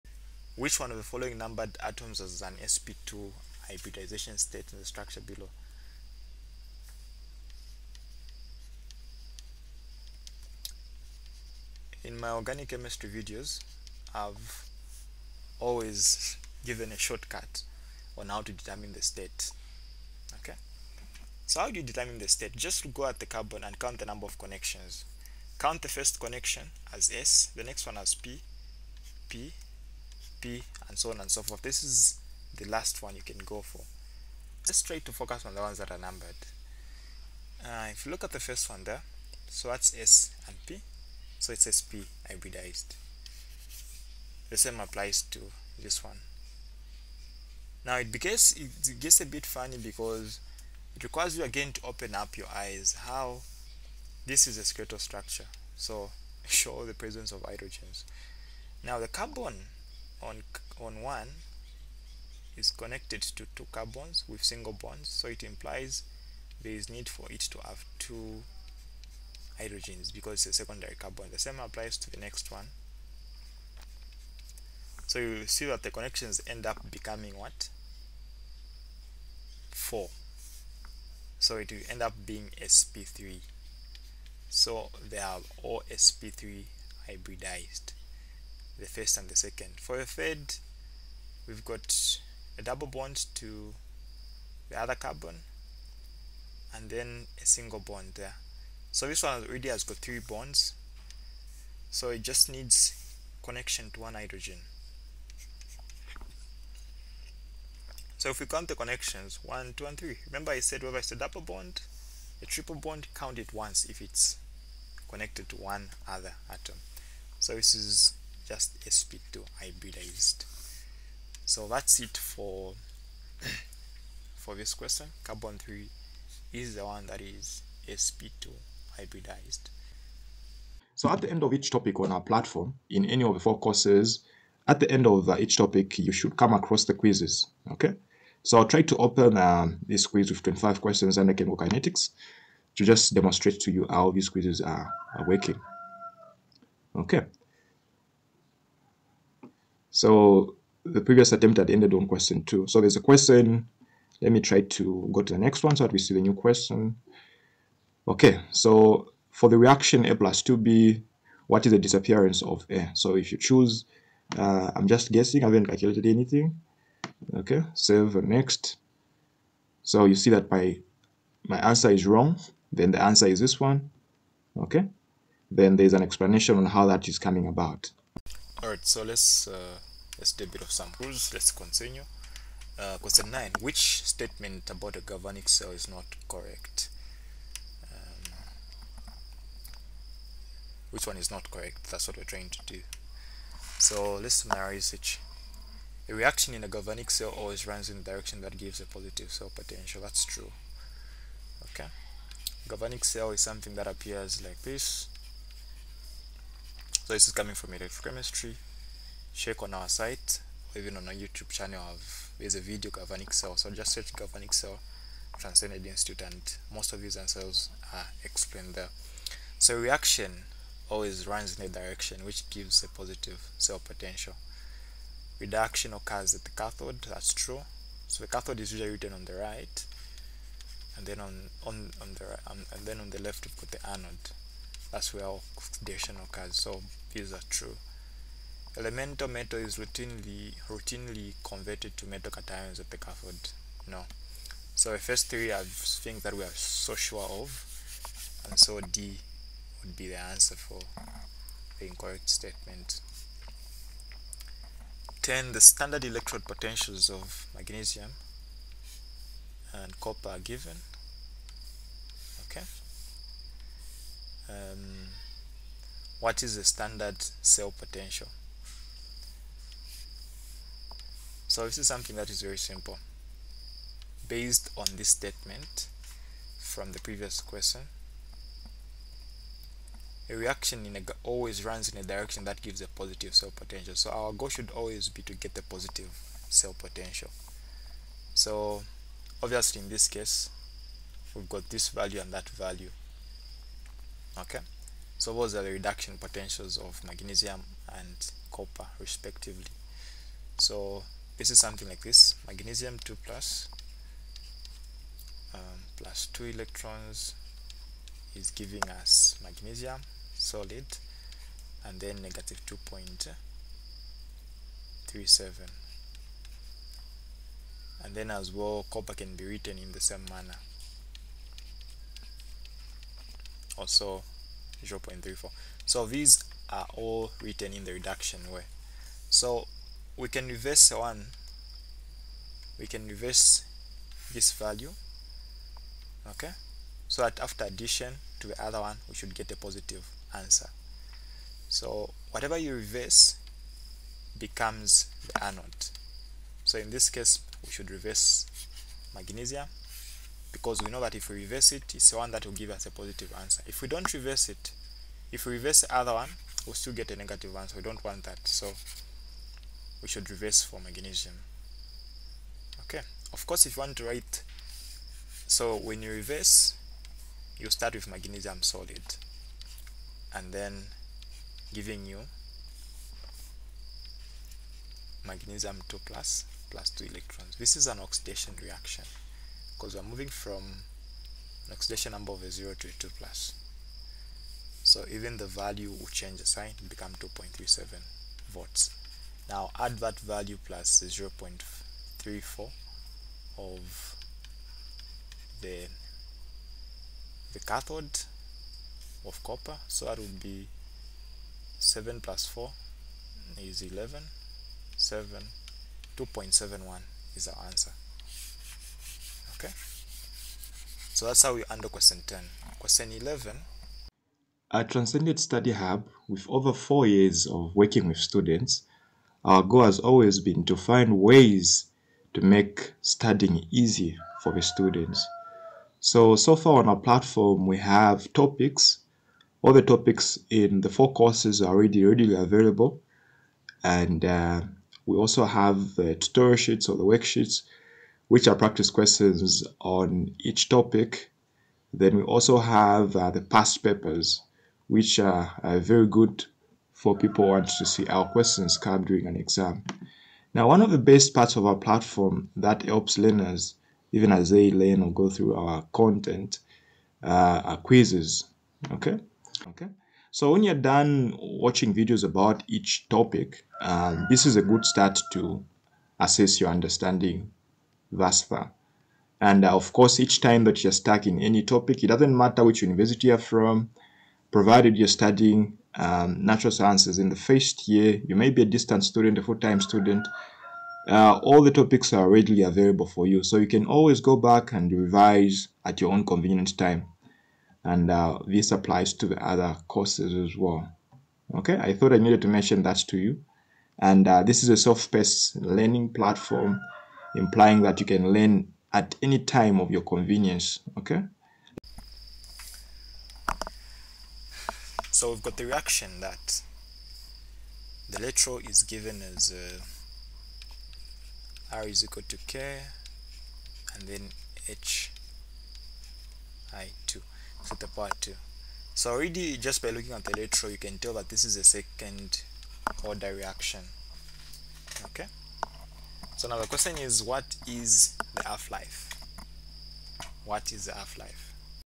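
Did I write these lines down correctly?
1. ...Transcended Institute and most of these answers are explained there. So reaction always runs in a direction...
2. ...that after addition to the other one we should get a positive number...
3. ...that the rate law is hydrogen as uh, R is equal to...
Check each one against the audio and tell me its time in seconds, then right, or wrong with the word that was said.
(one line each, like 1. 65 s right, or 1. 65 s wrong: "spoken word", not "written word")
1. 215 s right
2. 337 s wrong: "answer", not "number"
3. 506 s wrong: "given", not "hydrogen".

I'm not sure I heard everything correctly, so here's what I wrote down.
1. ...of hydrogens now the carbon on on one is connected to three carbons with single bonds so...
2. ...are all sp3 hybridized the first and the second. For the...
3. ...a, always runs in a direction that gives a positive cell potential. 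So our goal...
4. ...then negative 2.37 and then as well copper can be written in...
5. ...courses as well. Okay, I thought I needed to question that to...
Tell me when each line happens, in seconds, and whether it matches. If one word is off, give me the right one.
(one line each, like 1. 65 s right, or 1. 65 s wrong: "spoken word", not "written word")
1. 57 s wrong: "two", not "three"
2. 85 s right
3. 280 s right
4. 311 s right
5. 489 s wrong: "mention", not "question".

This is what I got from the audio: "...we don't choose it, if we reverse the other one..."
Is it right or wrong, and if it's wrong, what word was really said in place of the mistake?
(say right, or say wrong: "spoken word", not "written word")
wrong: "reverse", not "choose".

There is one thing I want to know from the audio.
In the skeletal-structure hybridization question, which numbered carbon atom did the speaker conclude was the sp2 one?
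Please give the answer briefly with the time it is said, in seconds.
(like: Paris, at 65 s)
Carbon 3, at 125 s.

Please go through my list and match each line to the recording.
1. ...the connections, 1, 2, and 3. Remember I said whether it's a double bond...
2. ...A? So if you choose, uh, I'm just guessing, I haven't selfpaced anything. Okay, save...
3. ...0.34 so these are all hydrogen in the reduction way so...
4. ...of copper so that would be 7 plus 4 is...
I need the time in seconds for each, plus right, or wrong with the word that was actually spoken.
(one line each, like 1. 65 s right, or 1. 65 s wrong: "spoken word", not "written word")
1. 108 s right
2. 162 s wrong: "calculated", not "selfpaced"
3. 324 s wrong: "written", not "hydrogen"
4. 399 s right.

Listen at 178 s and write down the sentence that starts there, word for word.
Alright, so let's uh, let's do a bit of some rules.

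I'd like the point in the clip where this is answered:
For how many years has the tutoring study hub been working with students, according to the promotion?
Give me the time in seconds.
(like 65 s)
416 s.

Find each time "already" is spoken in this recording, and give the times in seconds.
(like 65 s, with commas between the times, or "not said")
99 s, 431 s, 519 s.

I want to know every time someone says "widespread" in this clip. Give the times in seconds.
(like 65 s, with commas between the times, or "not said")
not said.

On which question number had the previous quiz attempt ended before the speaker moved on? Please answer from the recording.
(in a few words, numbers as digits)
Question two.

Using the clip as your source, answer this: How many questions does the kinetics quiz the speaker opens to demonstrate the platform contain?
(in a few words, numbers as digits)
25.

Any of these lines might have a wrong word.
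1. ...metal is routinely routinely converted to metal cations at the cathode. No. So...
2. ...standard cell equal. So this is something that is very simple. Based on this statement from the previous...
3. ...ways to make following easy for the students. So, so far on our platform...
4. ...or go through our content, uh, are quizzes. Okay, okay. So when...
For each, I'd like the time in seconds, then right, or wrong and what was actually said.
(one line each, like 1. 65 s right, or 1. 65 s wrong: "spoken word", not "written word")
1. 239 s right
2. 266 s wrong: "potential", not "equal"
3. 421 s wrong: "studying", not "following"
4. 455 s right.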